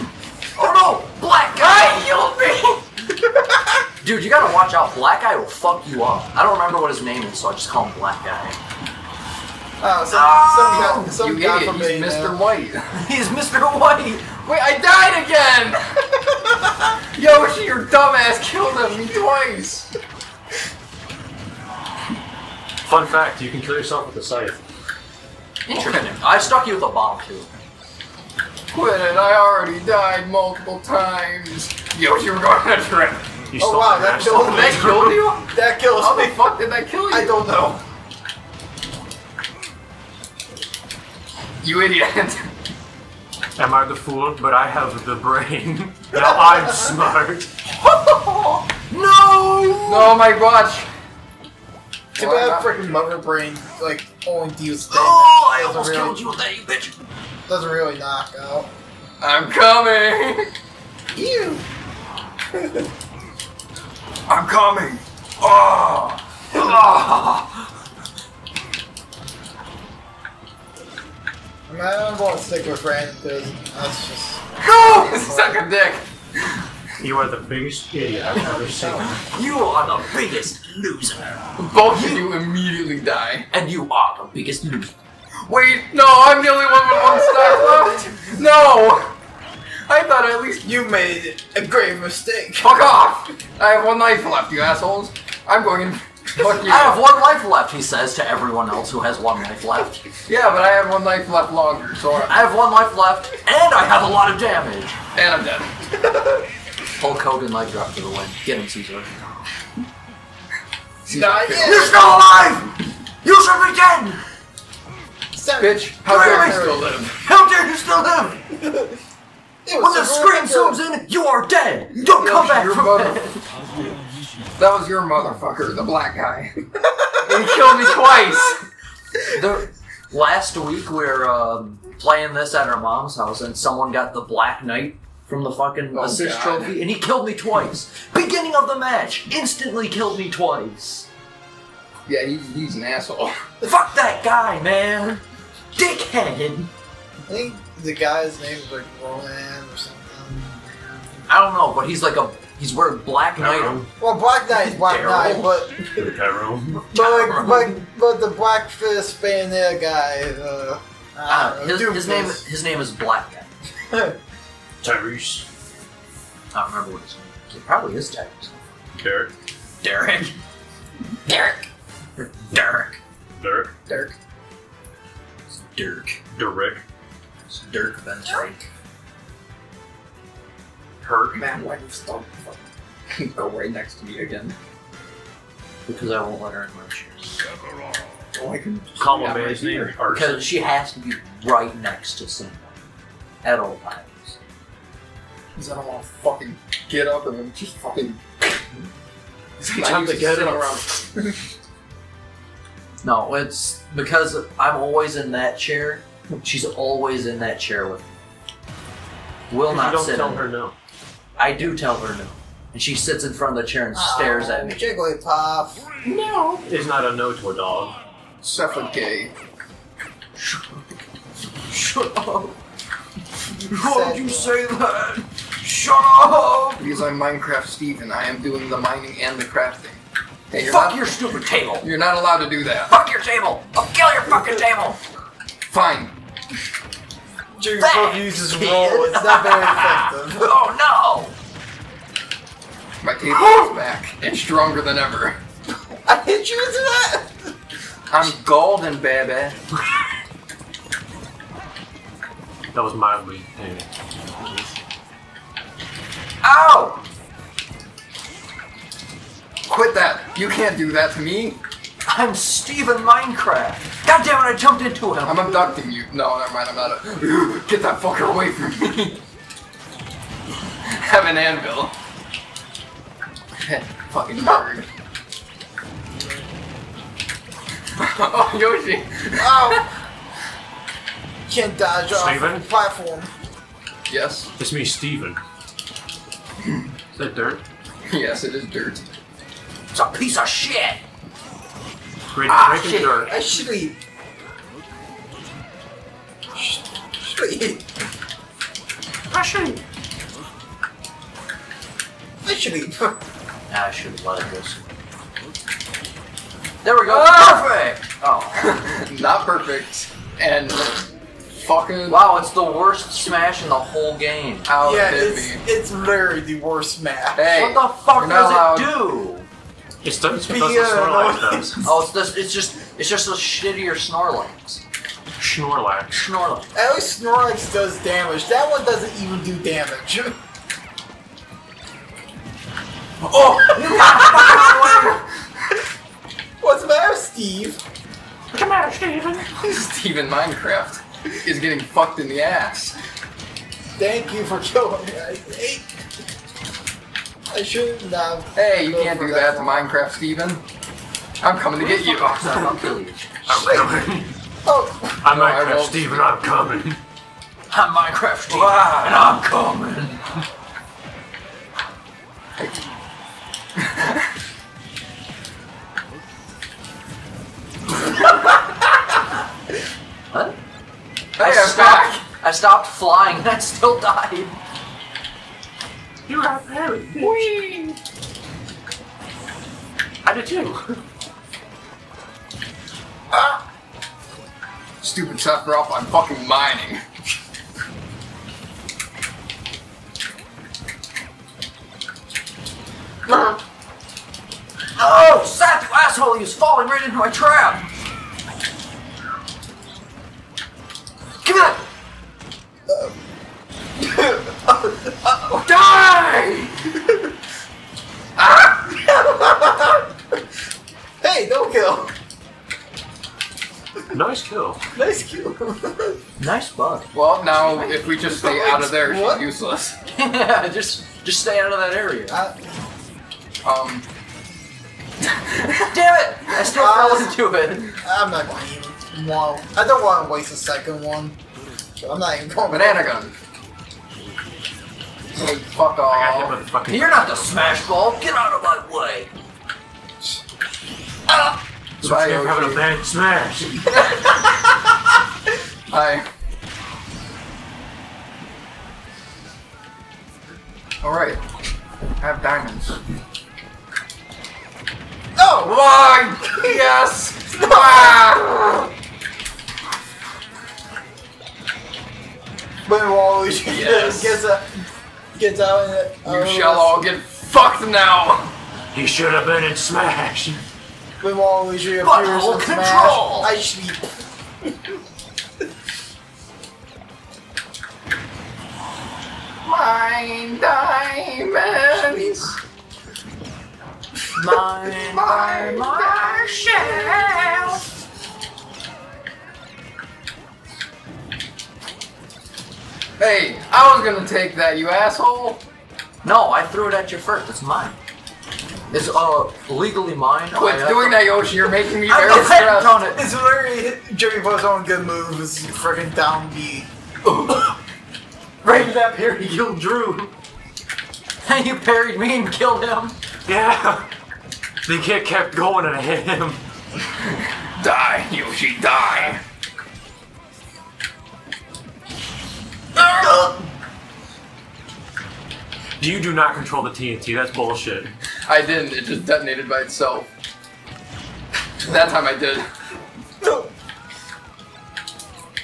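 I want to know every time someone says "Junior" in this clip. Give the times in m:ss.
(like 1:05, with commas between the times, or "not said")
3:57.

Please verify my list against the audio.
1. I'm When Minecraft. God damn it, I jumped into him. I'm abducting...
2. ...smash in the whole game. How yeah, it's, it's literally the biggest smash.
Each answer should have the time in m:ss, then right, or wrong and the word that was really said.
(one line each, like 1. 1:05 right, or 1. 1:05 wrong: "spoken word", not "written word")
1. 4:22 wrong: "Steven", not "When"
2. 5:13 wrong: "worst", not "biggest".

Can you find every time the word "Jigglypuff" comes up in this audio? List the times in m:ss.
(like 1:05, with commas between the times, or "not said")
3:34.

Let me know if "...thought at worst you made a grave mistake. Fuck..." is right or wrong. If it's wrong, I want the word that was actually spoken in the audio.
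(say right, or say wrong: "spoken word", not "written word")
wrong: "least", not "worst".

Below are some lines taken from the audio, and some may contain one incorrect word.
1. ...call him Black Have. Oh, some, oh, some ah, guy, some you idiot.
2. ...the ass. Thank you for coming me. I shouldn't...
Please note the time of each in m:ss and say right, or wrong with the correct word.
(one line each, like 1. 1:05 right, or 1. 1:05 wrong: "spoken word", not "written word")
1. 0:07 wrong: "Guy", not "Have"
2. 5:42 wrong: "killing", not "coming".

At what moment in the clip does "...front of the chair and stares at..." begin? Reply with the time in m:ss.
3:33.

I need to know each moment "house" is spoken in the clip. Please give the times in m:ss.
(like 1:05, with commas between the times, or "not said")
2:13.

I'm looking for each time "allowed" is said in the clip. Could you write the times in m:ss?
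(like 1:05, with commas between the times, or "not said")
3:52.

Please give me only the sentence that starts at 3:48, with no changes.
I am doing the mining and the crafting.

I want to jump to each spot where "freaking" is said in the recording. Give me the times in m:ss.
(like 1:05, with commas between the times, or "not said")
0:52, 8:25.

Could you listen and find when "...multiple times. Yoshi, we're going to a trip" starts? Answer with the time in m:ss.
0:30.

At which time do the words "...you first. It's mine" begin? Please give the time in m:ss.
8:17.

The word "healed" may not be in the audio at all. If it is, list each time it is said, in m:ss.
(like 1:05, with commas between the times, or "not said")
0:02.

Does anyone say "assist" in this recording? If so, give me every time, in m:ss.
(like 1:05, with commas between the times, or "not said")
2:16.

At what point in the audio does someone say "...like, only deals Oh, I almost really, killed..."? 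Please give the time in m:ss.
0:53.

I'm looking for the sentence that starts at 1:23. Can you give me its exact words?
And you are the biggest loser.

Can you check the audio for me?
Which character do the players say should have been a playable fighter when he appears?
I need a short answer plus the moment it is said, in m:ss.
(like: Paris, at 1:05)
Waluigi, at 7:51.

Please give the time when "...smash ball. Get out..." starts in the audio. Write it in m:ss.
7:17.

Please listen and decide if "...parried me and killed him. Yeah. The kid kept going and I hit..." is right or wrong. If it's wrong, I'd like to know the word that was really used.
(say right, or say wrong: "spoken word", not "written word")
right.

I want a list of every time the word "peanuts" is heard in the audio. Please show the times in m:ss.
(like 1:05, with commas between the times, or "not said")
not said.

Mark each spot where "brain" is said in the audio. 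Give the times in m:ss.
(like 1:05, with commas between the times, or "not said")
0:45, 0:53.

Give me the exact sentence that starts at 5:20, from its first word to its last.
It's don't it's because the uh, Snorlax does.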